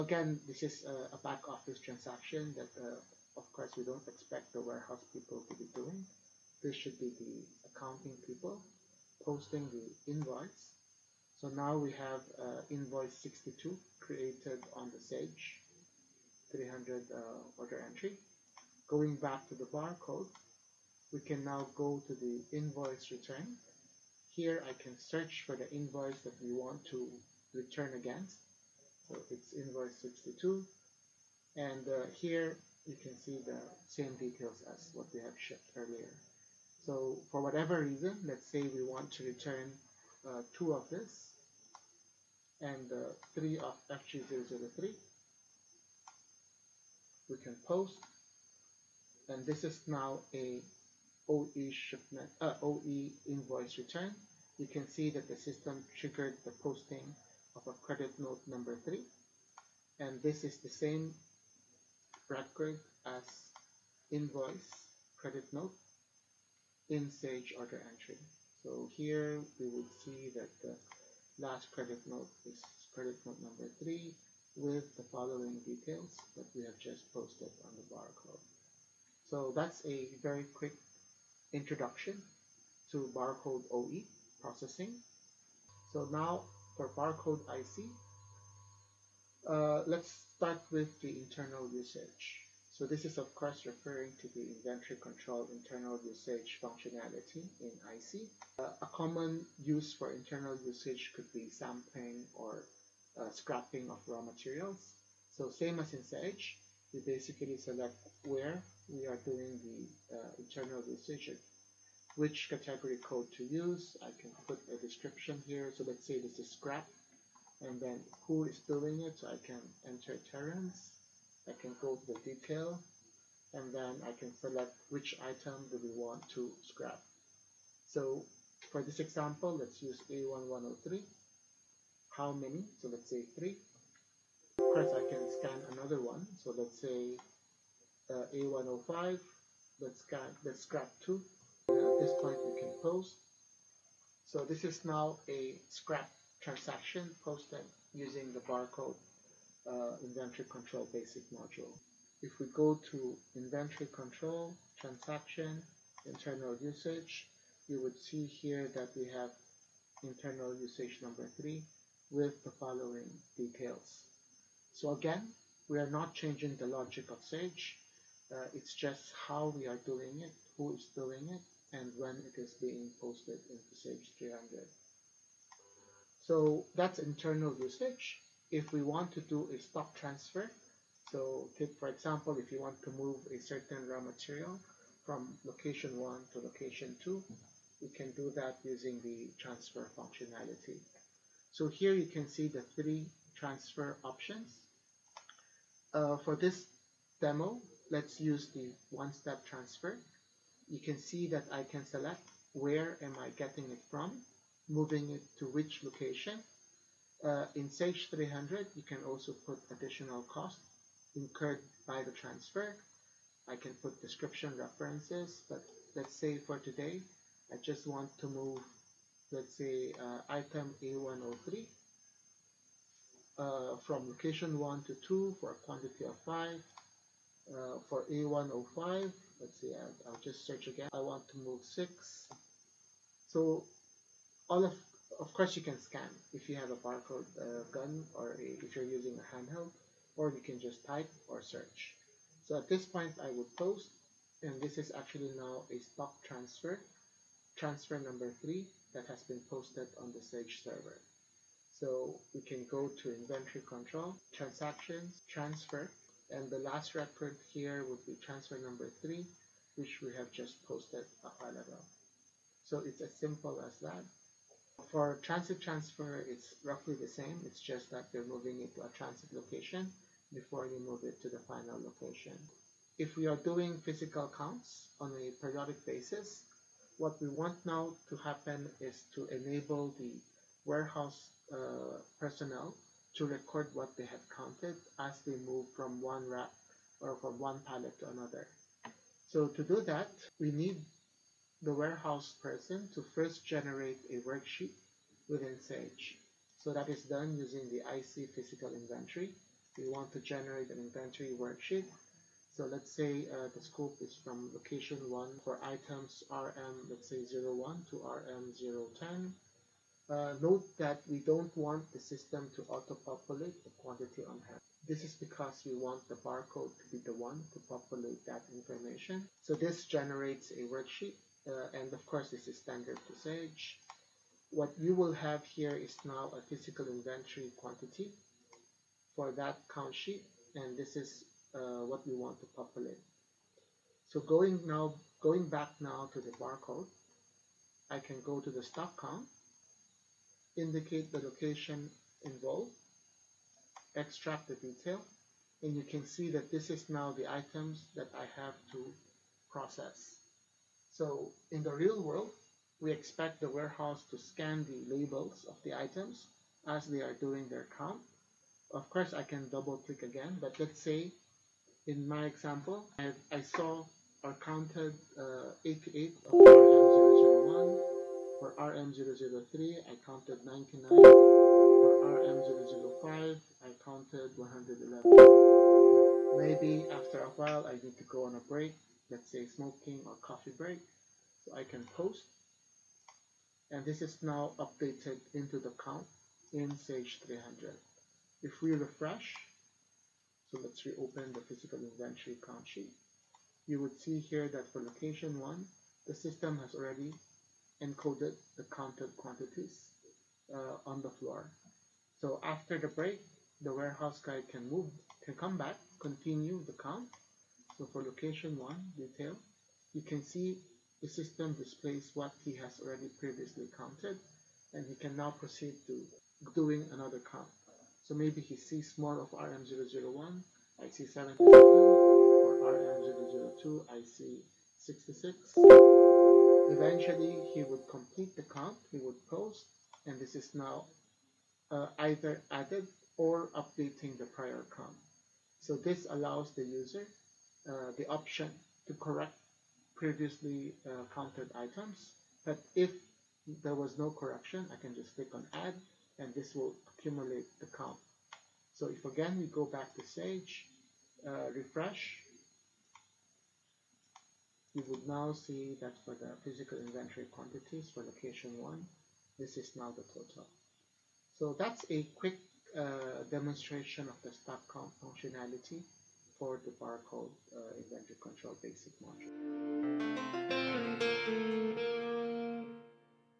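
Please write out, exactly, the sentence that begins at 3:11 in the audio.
So here you can see the three transfer options.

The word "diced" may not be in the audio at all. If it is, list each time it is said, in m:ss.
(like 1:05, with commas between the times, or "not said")
not said.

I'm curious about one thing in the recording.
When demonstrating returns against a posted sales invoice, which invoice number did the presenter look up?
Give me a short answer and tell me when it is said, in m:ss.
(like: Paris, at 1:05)
62, at 0:29.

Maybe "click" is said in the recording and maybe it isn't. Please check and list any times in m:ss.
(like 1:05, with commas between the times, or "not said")
5:59, 7:25.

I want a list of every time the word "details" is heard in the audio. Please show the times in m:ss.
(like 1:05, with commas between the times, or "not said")
0:34, 1:15, 2:02, 2:43, 5:44, 6:48.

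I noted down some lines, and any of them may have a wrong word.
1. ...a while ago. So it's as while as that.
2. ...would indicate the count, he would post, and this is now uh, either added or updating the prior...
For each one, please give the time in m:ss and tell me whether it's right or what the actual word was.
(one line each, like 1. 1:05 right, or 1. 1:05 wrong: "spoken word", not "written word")
1. 4:21 wrong: "simple", not "while"
2. 7:07 wrong: "complete", not "indicate".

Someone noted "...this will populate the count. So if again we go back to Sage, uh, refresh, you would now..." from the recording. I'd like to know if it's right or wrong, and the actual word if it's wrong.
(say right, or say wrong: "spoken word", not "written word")
wrong: "accumulate", not "populate".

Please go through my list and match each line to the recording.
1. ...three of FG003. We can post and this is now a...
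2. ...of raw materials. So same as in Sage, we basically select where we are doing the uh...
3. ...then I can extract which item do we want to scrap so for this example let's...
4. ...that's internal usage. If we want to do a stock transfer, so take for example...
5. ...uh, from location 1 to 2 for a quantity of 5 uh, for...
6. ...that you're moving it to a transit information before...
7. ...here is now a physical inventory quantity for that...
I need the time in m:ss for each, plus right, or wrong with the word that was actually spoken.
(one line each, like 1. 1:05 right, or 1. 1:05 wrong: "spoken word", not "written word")
1. 0:43 right
2. 1:43 right
3. 2:03 wrong: "select", not "extract"
4. 2:56 right
5. 3:43 right
6. 4:27 wrong: "location", not "information"
7. 5:25 right.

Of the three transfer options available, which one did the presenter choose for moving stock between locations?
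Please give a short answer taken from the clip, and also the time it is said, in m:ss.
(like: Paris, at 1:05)
one-step transfer, at 3:18.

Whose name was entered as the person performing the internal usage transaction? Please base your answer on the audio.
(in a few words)
Terence.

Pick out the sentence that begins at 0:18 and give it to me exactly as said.
Going back to the barcode, we can now go to the invoice return.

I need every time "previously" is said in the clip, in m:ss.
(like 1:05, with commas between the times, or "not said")
6:53, 7:19.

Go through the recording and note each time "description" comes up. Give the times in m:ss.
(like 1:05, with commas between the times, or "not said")
1:54, 3:34.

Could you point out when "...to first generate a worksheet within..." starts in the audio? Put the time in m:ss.
4:52.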